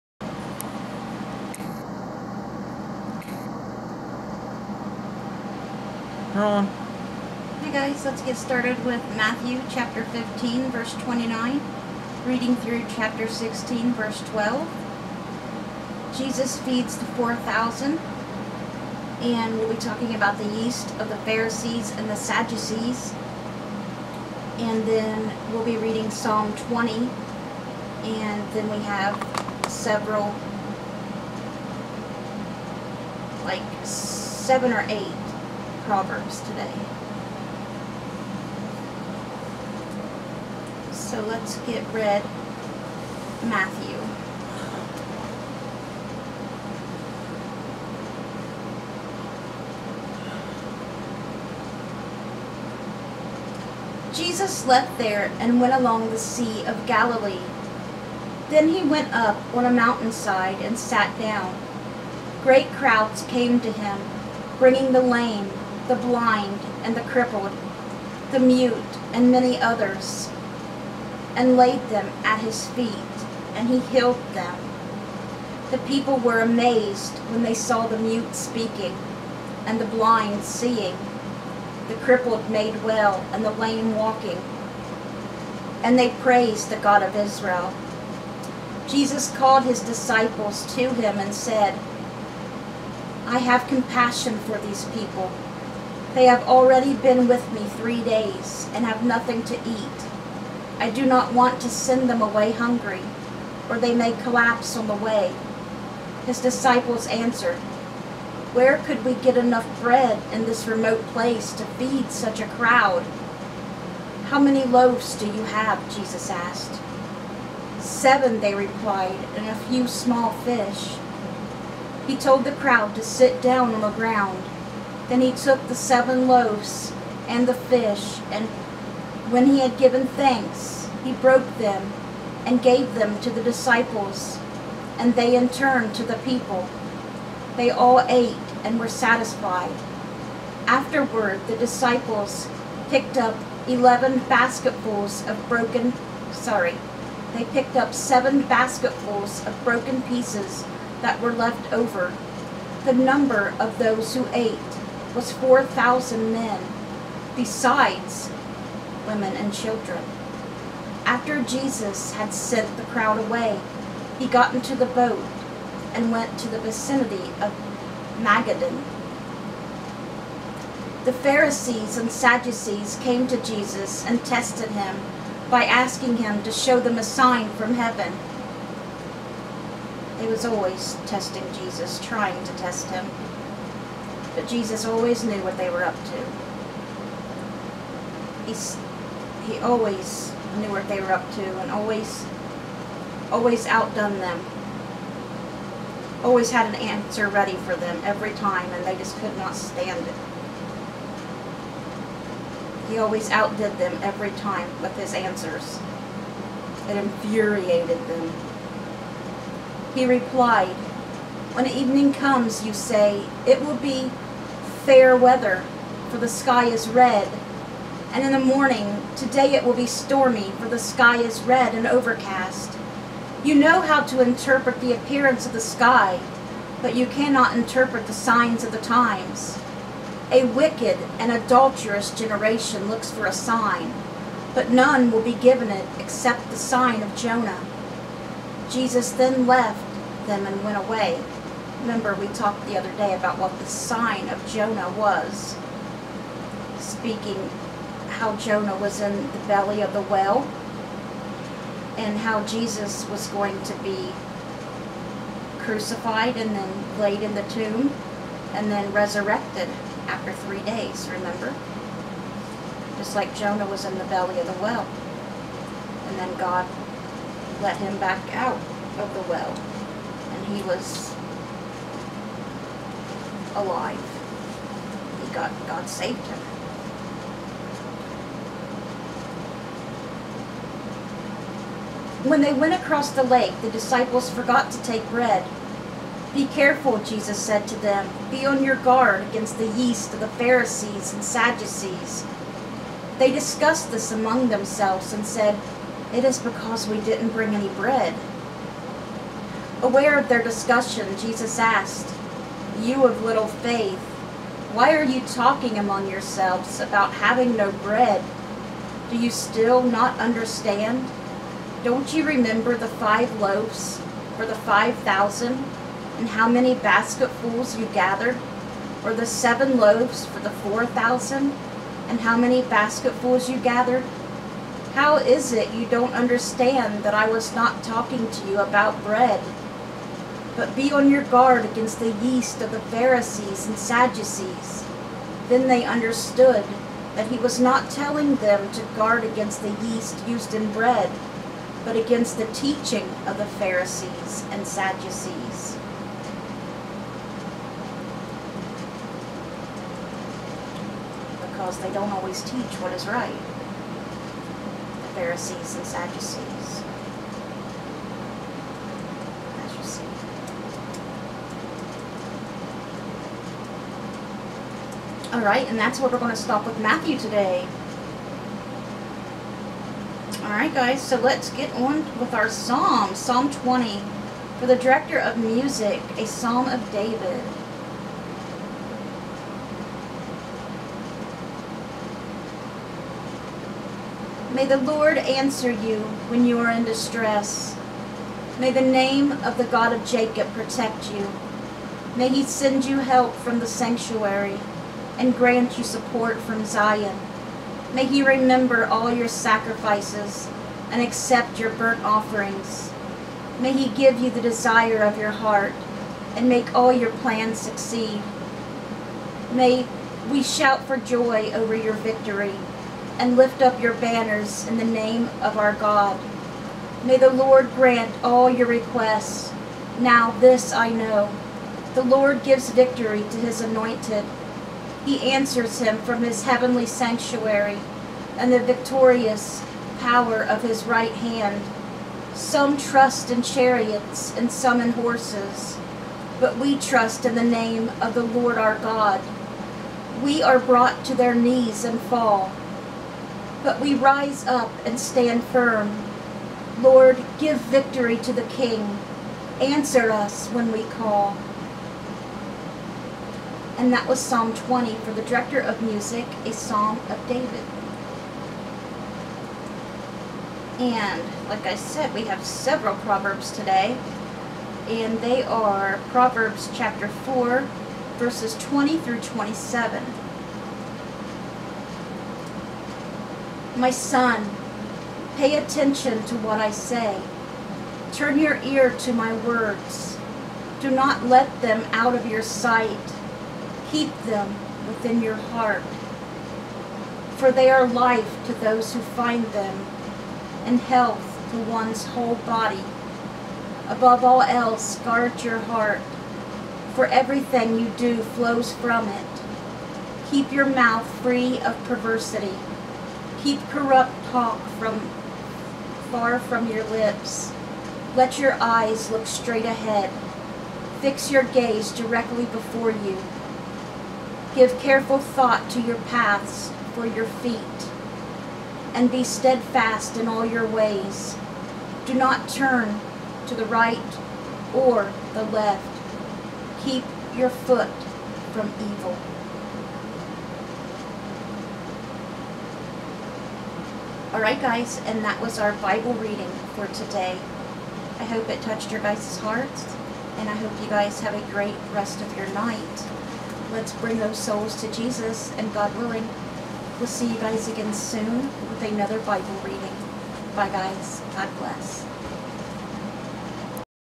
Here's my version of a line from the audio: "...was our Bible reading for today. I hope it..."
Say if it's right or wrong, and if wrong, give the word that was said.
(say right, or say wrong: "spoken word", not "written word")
right.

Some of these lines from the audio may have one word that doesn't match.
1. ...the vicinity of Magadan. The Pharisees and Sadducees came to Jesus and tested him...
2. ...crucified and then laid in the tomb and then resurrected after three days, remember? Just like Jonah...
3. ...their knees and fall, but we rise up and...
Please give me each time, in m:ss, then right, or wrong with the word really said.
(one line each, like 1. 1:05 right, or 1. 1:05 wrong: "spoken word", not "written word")
1. 2:46 right
2. 4:15 right
3. 7:21 right.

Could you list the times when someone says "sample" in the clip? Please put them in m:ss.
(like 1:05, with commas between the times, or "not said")
not said.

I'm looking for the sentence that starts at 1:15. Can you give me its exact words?
The people were amazed when they saw the mute speaking, and the blind seeing, the crippled made well, and the lame walking.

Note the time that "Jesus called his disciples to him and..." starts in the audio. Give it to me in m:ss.
1:28.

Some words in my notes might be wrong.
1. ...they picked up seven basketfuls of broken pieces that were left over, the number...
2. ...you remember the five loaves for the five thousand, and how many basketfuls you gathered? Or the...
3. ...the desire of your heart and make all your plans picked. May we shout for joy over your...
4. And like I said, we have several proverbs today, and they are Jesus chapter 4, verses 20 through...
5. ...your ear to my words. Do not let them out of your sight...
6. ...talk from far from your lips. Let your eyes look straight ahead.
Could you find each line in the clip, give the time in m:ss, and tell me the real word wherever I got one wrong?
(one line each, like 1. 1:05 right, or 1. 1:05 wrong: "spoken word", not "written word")
1. 2:27 right
2. 5:12 right
3. 6:44 wrong: "succeed", not "picked"
4. 7:40 wrong: "Proverbs", not "Jesus"
5. 7:58 right
6. 8:24 right.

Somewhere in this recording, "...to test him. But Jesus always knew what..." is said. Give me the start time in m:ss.
3:02.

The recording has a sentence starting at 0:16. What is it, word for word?
Jesus feeds the 4,000, and we'll be talking about the yeast of the Pharisees and the Sadducees.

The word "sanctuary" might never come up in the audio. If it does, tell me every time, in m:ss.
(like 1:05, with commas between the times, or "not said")
6:33, 7:06.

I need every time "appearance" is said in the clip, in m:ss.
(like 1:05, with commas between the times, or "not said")
3:44.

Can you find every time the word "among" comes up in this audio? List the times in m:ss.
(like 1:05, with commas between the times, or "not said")
4:54, 5:05.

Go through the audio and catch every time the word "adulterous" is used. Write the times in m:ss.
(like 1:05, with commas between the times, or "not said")
3:51.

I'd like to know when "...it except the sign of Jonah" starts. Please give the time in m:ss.
3:55.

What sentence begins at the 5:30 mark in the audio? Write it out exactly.
But be on your guard against the yeast of the Pharisees and Sadducees.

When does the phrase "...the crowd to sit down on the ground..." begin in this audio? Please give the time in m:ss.
2:02.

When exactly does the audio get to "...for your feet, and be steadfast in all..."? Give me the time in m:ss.
8:36.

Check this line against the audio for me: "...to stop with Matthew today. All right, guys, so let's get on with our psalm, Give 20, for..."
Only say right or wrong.
wrong.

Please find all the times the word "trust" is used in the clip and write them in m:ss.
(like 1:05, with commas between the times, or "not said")
7:12, 7:16.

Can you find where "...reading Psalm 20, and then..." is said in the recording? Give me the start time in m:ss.
0:25.